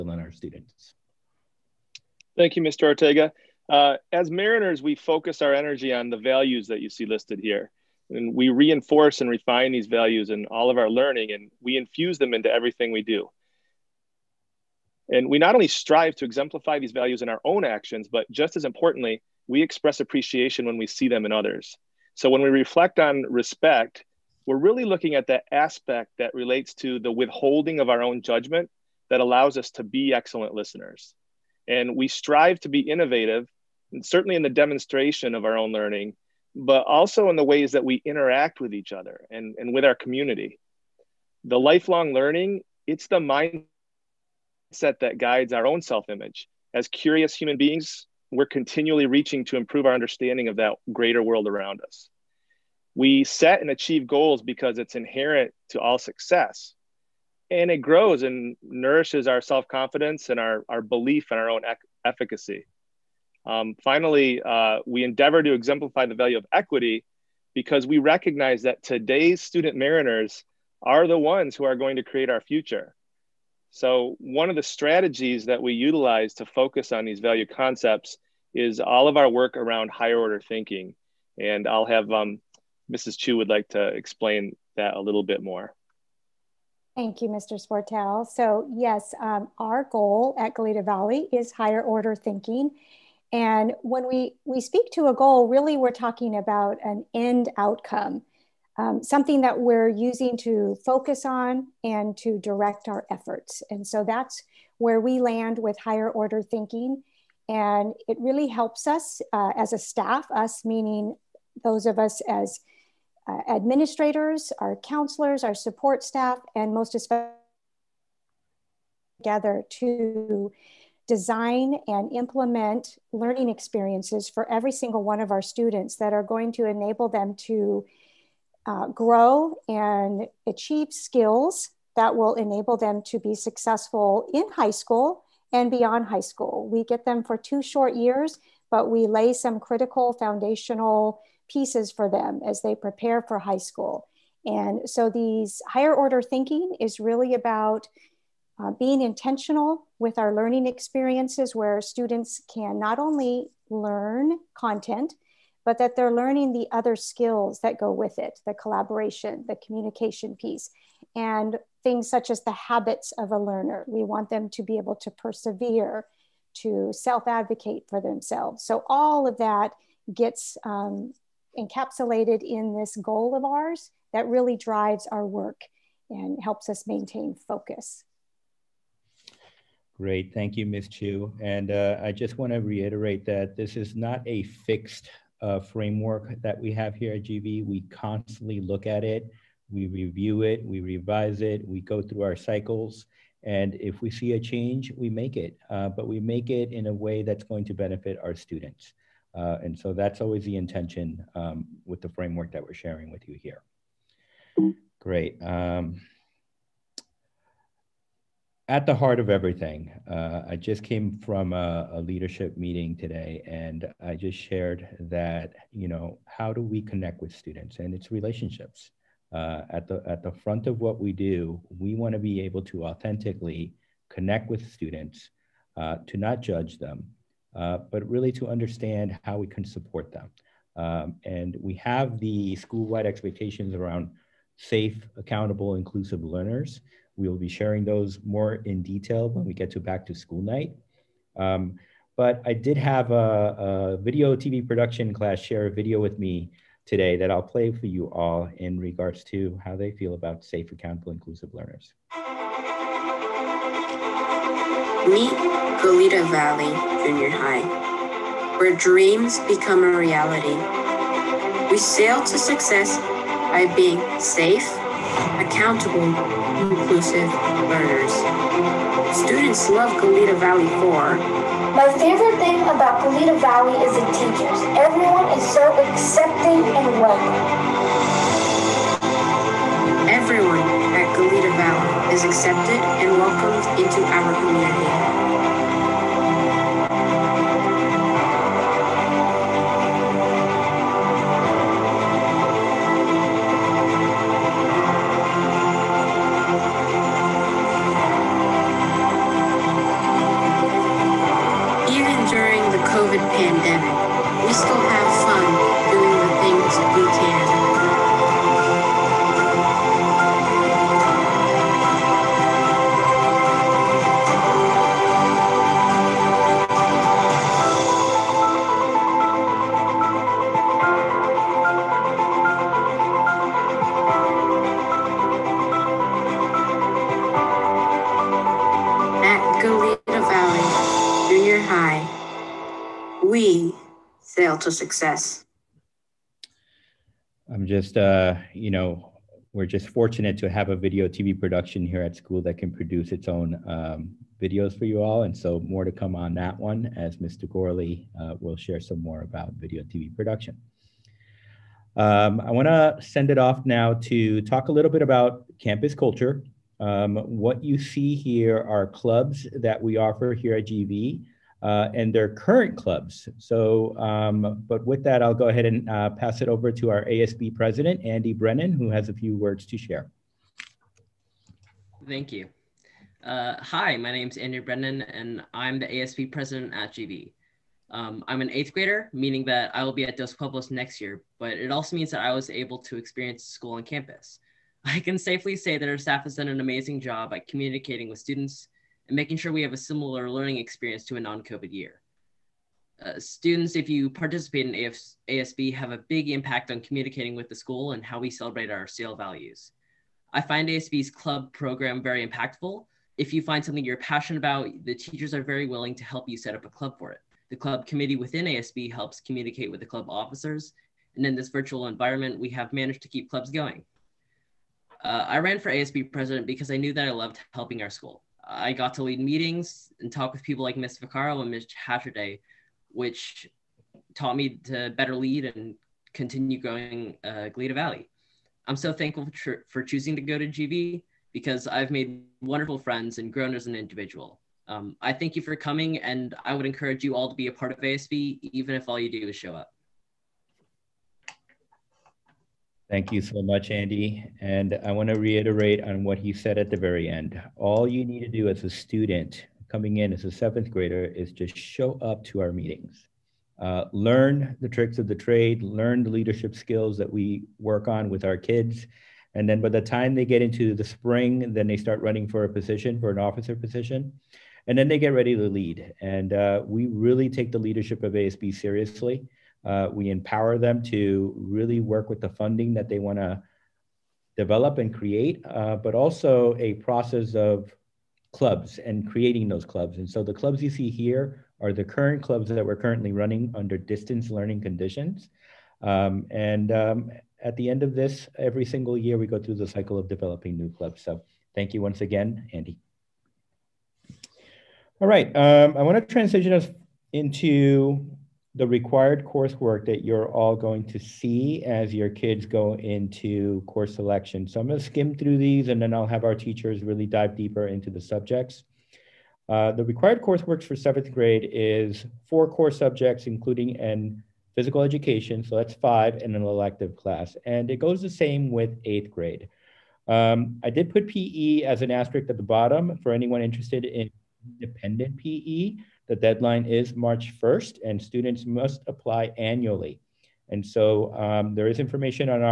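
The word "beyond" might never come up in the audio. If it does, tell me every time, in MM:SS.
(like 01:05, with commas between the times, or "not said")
02:15.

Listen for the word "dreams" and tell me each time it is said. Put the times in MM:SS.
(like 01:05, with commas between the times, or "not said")
04:18.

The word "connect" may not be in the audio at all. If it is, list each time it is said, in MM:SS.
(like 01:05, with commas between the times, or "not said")
03:36, 03:44.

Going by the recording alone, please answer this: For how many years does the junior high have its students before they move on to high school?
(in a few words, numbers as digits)
2.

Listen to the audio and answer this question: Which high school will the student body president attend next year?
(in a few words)
Dos Pueblos.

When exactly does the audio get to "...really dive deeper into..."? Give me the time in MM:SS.
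08:26.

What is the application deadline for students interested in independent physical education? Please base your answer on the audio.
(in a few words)
March 1st.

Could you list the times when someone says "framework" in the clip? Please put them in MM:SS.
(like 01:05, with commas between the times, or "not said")
03:05, 03:22.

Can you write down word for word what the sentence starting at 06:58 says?
I got to lead meetings and talk with people like Ms.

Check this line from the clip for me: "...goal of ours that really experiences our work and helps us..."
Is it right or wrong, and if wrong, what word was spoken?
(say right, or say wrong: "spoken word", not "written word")
wrong: "drives", not "experiences".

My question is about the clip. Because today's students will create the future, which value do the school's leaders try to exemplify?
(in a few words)
equity.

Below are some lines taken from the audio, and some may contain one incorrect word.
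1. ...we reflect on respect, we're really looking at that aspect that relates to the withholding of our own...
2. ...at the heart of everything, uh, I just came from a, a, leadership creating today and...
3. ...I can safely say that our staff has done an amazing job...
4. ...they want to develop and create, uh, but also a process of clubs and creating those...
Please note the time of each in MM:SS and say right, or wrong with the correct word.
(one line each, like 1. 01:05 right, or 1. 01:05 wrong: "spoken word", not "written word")
1. 00:22 right
2. 03:28 wrong: "meeting", not "creating"
3. 06:24 right
4. 07:52 right.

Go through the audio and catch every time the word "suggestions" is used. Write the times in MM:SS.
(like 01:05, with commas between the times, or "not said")
not said.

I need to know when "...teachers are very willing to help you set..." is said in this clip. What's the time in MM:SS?
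06:44.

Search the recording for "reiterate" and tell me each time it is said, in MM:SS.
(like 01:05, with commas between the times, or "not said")
03:02, 07:25.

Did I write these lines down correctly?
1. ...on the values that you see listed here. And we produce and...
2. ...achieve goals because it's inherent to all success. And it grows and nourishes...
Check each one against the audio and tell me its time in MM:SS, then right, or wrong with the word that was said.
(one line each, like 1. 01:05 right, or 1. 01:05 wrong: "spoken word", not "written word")
1. 00:05 wrong: "reinforce", not "produce"
2. 00:53 right.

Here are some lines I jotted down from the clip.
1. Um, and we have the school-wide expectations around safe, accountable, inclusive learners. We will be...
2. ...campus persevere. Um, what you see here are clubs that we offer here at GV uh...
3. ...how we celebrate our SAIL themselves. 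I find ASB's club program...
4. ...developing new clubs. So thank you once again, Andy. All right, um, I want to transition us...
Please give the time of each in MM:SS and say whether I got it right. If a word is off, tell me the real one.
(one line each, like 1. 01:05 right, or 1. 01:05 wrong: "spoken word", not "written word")
1. 03:50 right
2. 05:55 wrong: "culture", not "persevere"
3. 06:38 wrong: "values", not "themselves"
4. 08:10 right.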